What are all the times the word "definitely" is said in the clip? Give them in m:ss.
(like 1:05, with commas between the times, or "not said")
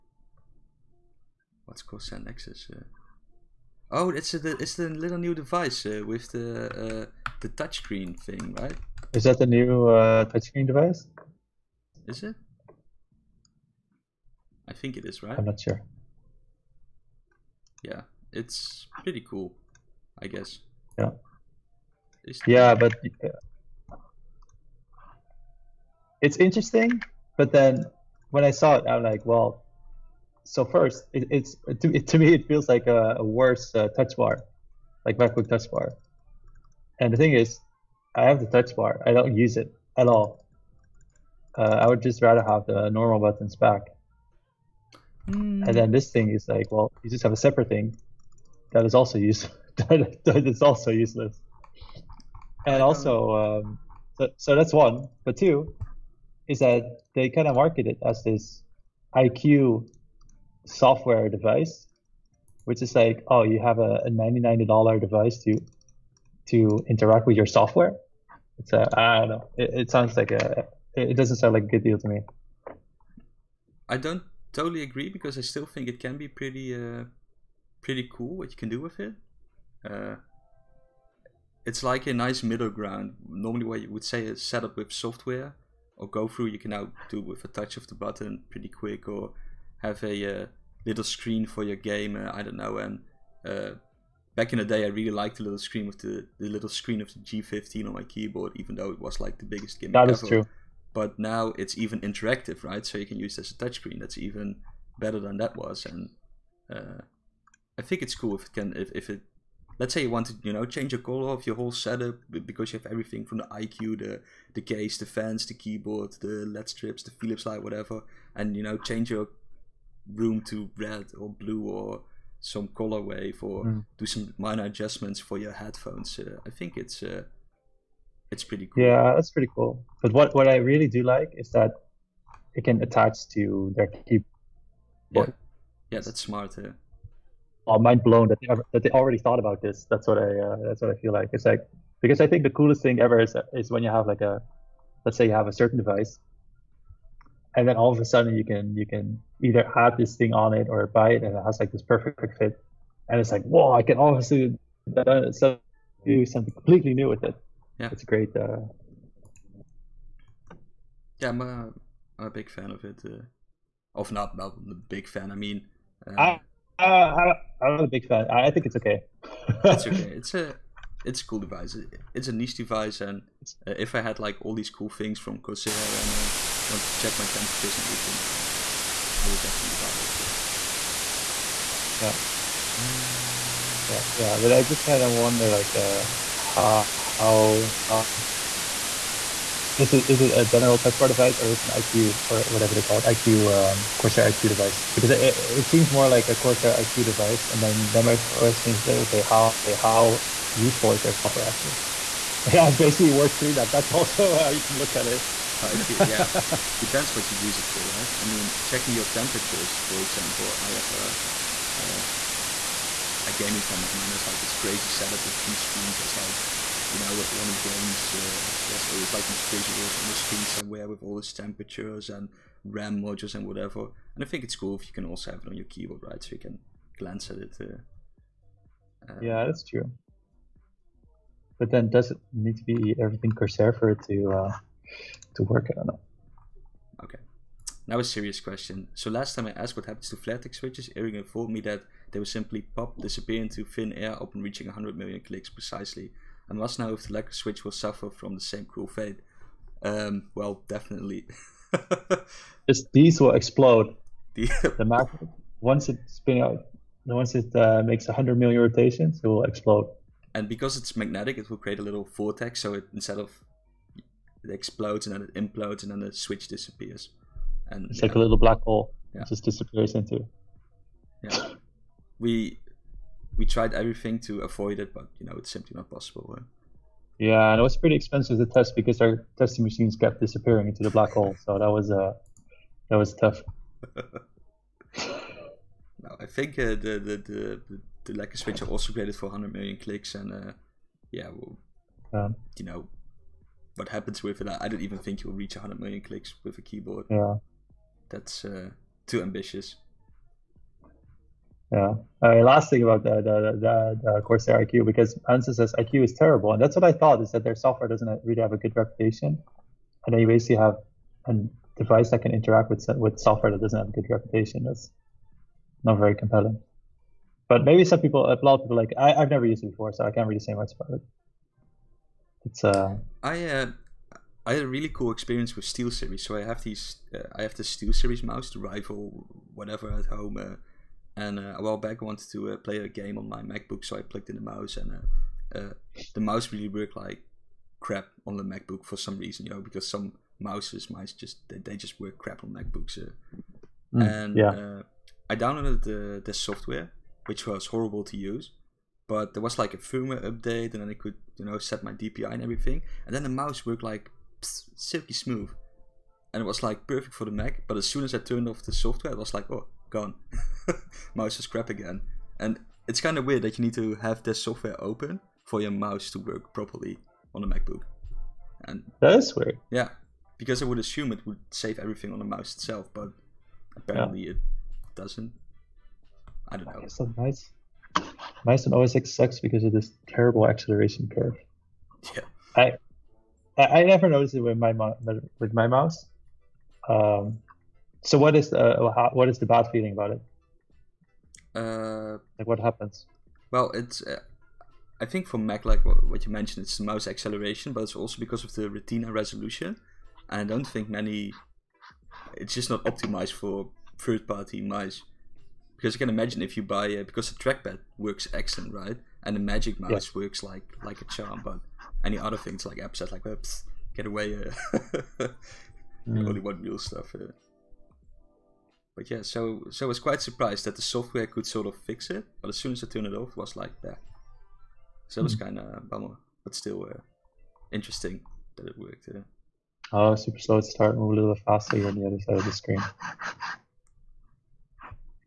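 2:59, 4:10.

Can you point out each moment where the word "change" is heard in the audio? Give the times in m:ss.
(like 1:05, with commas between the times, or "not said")
1:50, 1:58.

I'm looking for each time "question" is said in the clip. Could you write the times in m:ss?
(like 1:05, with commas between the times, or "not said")
3:18, 3:58.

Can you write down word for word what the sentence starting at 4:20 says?
And because it's magnetic, it will create a little vortex.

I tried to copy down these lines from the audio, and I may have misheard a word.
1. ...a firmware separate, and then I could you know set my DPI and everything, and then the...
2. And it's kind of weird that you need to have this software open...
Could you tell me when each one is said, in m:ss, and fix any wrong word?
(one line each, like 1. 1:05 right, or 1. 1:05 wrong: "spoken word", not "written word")
1. 5:49 wrong: "update", not "separate"
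2. 6:02 right.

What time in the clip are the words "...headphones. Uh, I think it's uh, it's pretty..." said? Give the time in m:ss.
2:05.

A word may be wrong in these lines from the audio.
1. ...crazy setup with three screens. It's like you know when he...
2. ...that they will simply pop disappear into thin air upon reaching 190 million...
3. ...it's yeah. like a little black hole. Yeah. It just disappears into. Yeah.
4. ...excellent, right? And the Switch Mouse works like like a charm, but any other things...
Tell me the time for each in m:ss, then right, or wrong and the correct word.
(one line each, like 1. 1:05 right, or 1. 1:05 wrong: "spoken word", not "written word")
1. 3:34 right
2. 4:01 wrong: "100", not "190"
3. 4:27 right
4. 6:48 wrong: "Magic", not "Switch".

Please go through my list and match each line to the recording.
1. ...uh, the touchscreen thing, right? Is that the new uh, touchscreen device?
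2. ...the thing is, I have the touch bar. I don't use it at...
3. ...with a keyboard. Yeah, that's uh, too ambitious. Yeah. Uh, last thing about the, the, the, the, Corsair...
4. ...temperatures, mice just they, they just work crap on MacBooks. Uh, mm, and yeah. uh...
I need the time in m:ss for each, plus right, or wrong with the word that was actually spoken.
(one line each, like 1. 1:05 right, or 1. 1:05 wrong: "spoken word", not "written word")
1. 0:06 right
2. 0:37 right
3. 4:56 right
4. 5:40 wrong: "mouses", not "temperatures".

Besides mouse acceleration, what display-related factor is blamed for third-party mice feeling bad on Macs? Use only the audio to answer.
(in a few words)
Retina resolution.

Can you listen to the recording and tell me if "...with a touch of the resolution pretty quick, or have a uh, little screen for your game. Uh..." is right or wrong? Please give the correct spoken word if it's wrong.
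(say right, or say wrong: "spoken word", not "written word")
wrong: "button", not "resolution".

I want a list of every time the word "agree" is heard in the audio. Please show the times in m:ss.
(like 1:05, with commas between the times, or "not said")
1:14.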